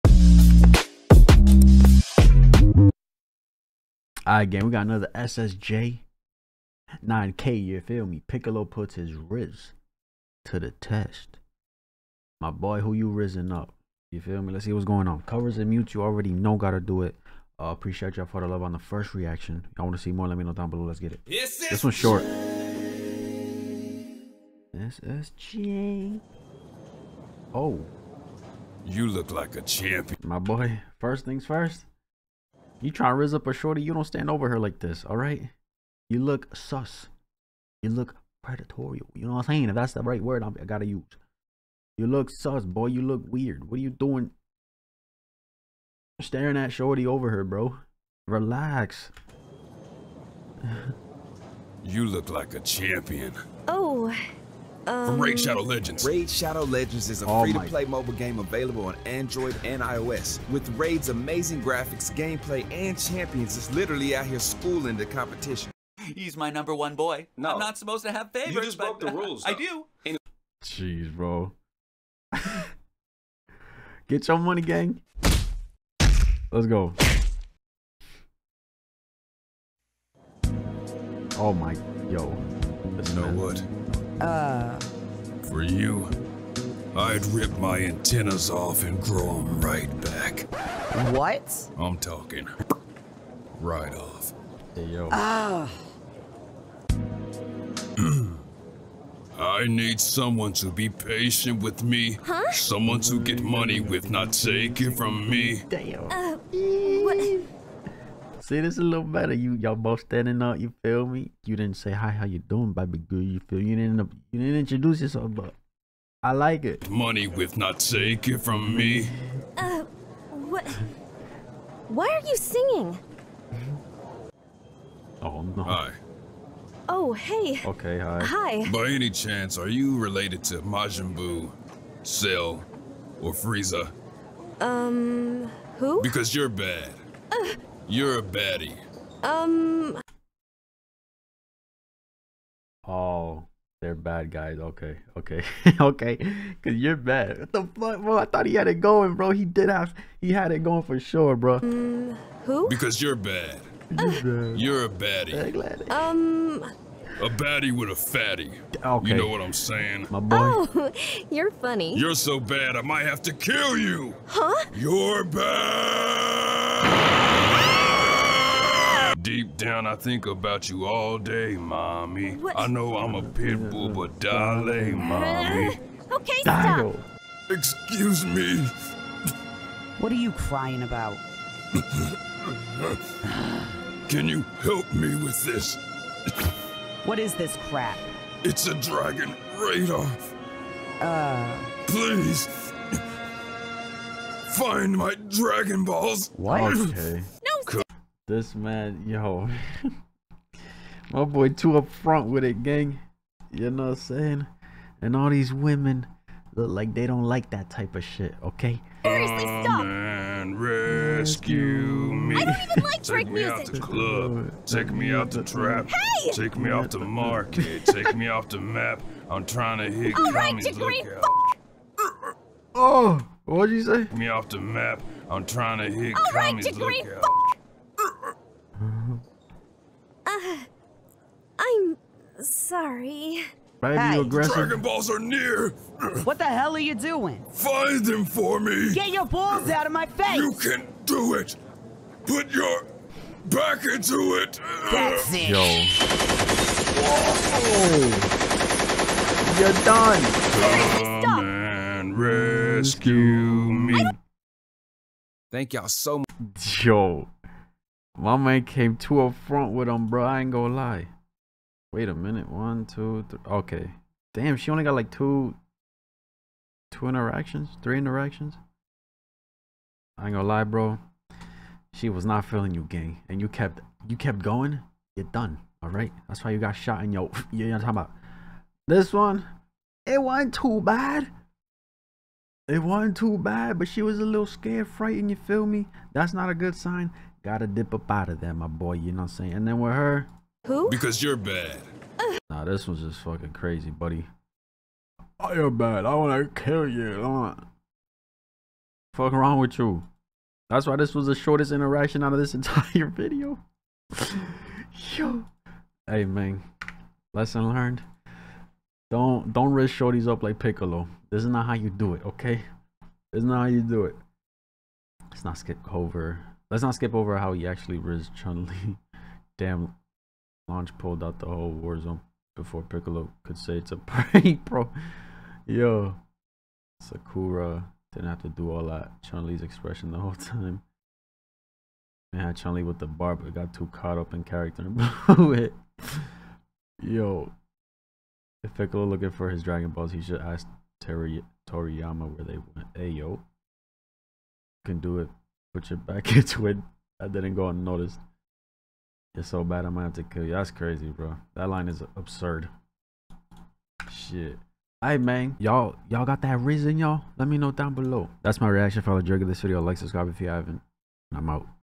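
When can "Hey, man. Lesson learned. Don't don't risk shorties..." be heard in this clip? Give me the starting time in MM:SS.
05:06.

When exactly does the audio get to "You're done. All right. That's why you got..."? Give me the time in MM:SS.
04:35.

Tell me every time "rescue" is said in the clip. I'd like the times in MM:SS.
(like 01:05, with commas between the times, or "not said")
03:30, 04:12.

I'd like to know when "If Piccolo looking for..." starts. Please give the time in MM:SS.
05:38.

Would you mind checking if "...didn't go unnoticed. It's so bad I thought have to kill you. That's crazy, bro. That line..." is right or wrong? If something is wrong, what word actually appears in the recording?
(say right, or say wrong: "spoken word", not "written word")
wrong: "might", not "thought".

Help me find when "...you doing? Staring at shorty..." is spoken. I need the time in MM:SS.
00:43.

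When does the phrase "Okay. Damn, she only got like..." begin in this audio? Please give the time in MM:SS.
04:23.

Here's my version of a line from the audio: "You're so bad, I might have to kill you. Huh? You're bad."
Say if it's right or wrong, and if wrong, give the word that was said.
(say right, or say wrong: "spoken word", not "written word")
right.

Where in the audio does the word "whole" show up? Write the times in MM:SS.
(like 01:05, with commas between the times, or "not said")
05:21, 05:30.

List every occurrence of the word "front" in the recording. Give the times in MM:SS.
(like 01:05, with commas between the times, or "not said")
03:21, 04:19.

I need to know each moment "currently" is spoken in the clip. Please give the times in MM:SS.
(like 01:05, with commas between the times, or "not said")
not said.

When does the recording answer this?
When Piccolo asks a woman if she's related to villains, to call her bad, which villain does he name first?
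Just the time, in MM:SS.
02:10.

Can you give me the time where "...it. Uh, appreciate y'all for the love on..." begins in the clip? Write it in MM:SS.
00:17.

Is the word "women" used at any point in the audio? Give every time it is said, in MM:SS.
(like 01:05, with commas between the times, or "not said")
03:25.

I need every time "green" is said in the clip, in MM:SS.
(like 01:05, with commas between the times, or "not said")
03:40, 03:46.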